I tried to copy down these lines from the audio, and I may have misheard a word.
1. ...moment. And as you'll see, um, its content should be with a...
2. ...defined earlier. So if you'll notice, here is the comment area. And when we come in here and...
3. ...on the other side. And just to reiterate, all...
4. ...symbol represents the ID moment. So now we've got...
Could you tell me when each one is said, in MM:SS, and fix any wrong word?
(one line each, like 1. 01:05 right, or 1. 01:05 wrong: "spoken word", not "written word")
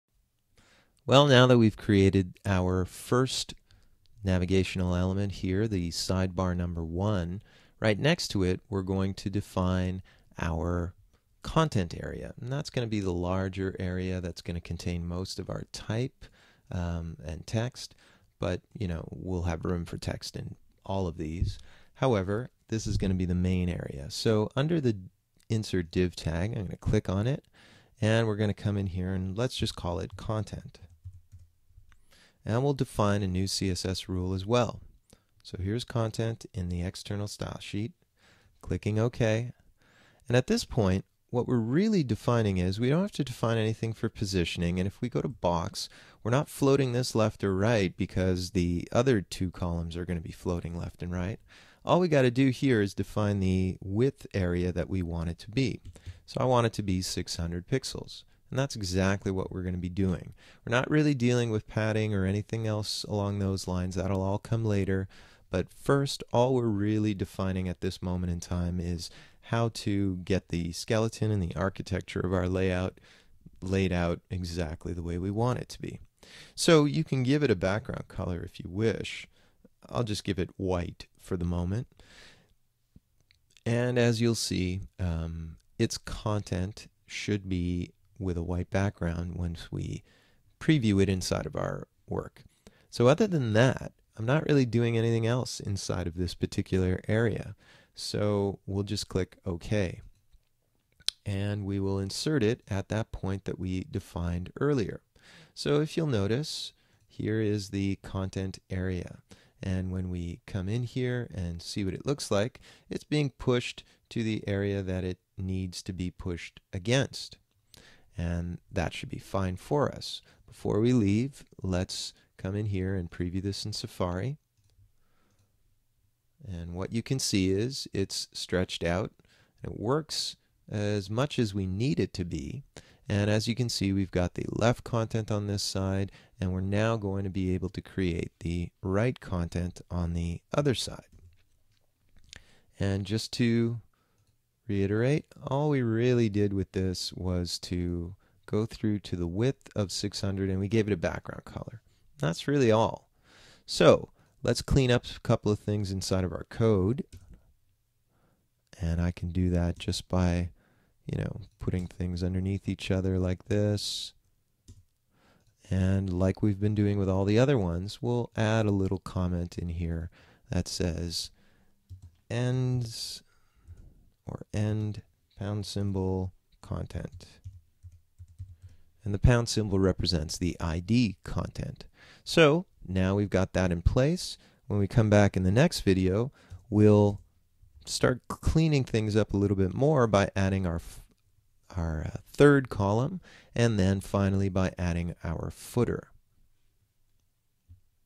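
1. 01:21 right
2. 01:43 wrong: "content", not "comment"
3. 02:19 right
4. 02:59 wrong: "content", not "moment".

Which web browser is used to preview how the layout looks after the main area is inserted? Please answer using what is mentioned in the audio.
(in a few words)
Safari.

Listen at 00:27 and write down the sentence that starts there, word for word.
And we're going to come in here and let's just call it content and we'll define a new CSS rule as well.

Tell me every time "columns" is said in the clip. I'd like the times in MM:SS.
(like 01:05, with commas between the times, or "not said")
00:49, 03:12.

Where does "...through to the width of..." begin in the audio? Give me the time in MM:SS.
02:28.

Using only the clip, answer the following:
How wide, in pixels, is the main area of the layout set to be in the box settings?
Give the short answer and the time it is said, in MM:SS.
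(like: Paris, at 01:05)
600, at 00:57.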